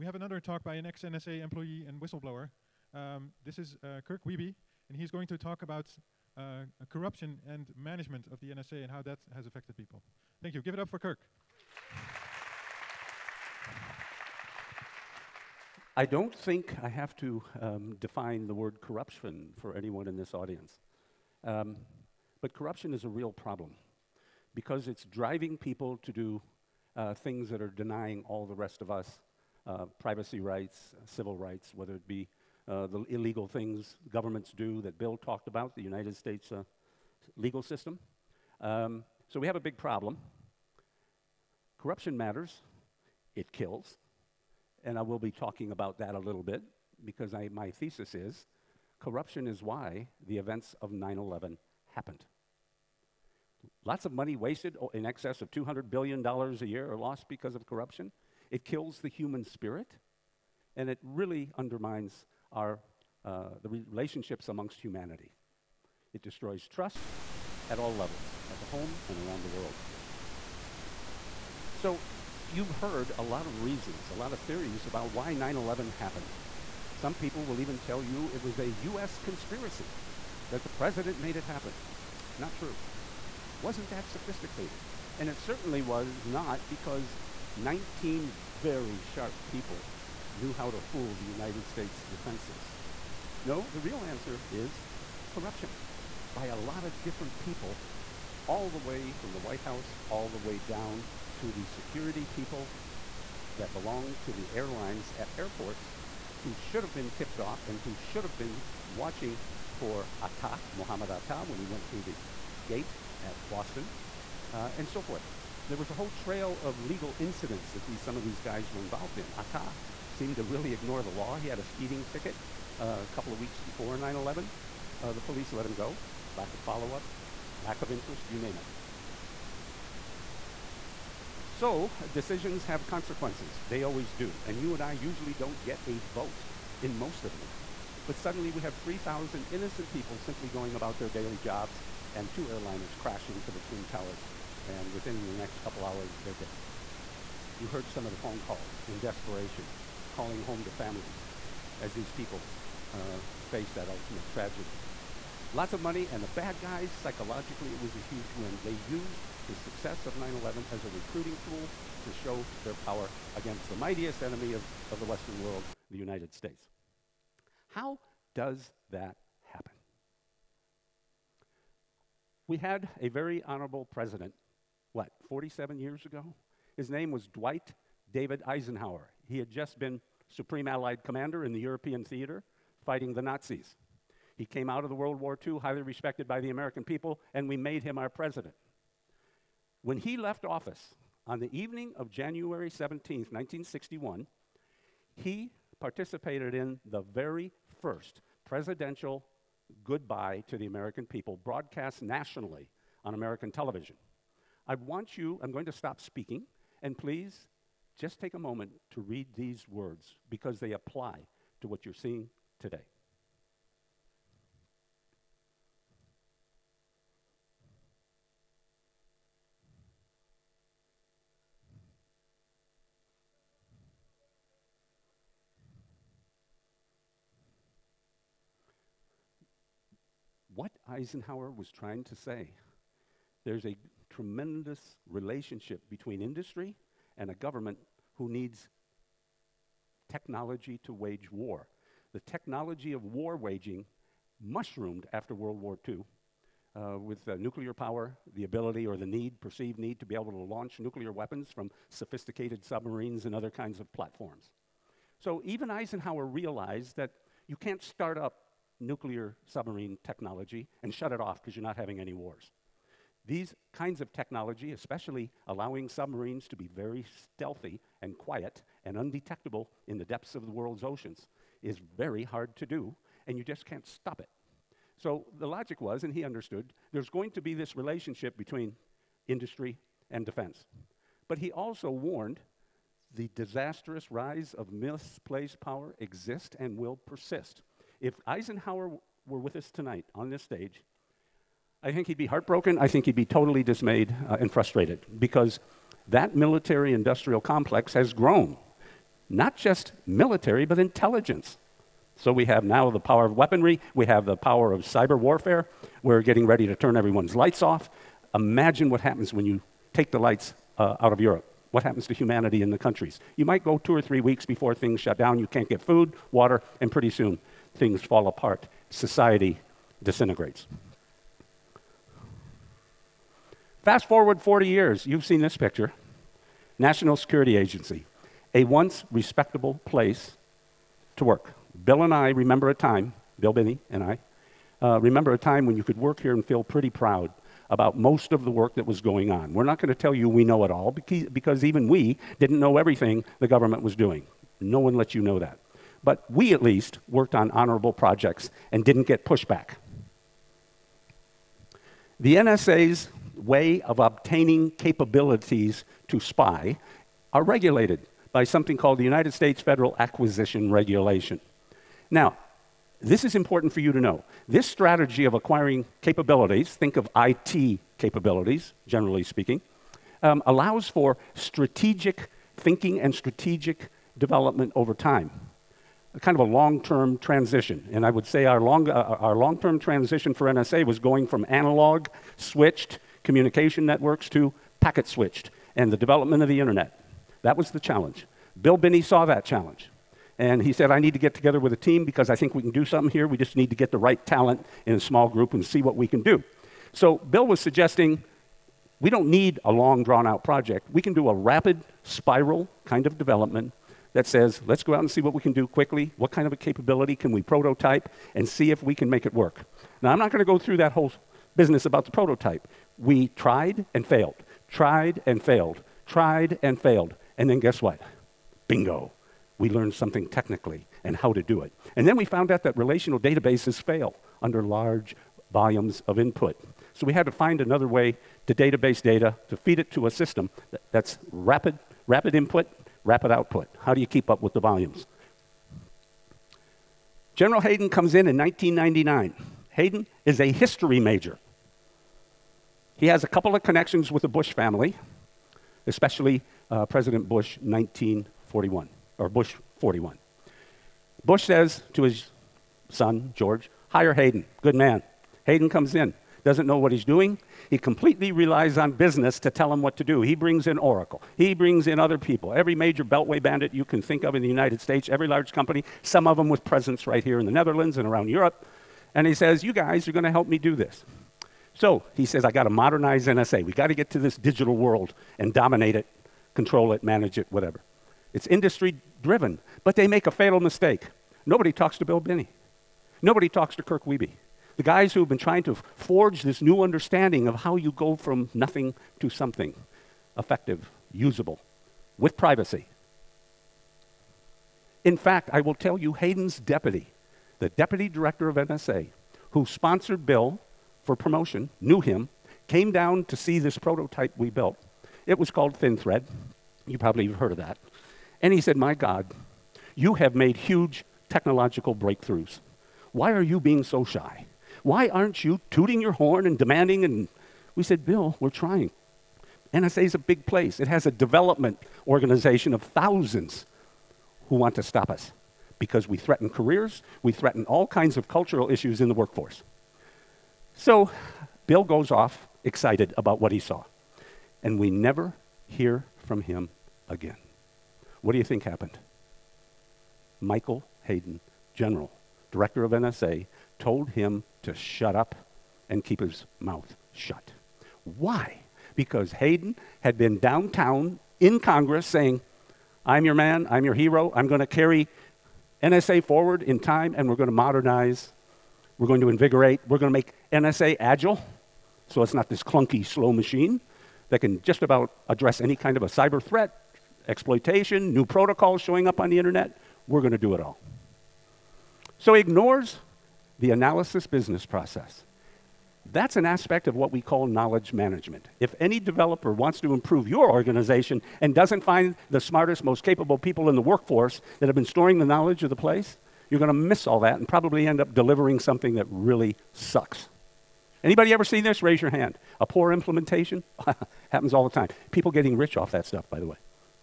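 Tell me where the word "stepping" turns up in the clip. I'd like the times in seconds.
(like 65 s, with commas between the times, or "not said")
not said.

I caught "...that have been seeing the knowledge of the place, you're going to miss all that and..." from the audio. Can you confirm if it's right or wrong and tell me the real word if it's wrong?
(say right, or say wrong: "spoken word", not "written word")
wrong: "storing", not "seeing".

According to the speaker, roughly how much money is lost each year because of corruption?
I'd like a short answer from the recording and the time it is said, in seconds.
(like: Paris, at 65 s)
$200 billion, at 55 s.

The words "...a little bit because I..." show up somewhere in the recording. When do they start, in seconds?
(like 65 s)
46 s.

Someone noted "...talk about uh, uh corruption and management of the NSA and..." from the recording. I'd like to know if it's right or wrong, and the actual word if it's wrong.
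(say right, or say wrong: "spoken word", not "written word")
right.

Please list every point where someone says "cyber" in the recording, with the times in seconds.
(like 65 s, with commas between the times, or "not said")
304 s, 566 s.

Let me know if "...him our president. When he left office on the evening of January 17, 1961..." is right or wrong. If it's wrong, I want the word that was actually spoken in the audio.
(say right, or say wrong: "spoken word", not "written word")
right.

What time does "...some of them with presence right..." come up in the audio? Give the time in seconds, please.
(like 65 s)
466 s.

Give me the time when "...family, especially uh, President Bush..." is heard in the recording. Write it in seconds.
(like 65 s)
444 s.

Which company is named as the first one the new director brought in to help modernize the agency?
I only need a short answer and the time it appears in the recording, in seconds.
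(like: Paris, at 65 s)
Oracle, at 460 s.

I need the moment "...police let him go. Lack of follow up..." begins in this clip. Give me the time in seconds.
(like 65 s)
125 s.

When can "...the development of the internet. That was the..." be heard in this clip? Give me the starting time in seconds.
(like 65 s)
385 s.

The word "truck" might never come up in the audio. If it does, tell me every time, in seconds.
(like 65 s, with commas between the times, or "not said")
not said.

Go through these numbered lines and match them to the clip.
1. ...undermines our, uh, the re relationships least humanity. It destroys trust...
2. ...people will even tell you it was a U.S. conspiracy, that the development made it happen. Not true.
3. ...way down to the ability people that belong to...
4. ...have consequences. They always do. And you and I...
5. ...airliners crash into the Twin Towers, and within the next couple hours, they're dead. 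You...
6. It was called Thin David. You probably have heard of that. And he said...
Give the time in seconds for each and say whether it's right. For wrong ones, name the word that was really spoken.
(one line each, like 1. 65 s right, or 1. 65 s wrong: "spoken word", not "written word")
1. 61 s wrong: "amongst", not "least"
2. 77 s wrong: "president", not "development"
3. 100 s wrong: "security", not "ability"
4. 132 s right
5. 142 s right
6. 505 s wrong: "Thread", not "David".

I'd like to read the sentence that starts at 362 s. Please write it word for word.
Now, this is important for you to know.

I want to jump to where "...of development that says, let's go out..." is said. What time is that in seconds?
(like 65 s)
403 s.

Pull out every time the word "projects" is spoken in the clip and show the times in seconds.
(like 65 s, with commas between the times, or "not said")
347 s, 400 s.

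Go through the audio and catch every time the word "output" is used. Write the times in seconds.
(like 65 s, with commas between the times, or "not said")
433 s.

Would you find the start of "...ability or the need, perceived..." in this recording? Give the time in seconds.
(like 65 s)
248 s.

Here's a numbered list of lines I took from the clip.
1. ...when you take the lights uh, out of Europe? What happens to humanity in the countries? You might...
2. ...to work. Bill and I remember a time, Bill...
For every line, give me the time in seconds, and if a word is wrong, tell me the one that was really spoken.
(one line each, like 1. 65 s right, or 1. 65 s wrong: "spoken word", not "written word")
1. 309 s right
2. 331 s right.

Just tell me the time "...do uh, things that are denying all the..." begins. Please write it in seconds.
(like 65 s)
26 s.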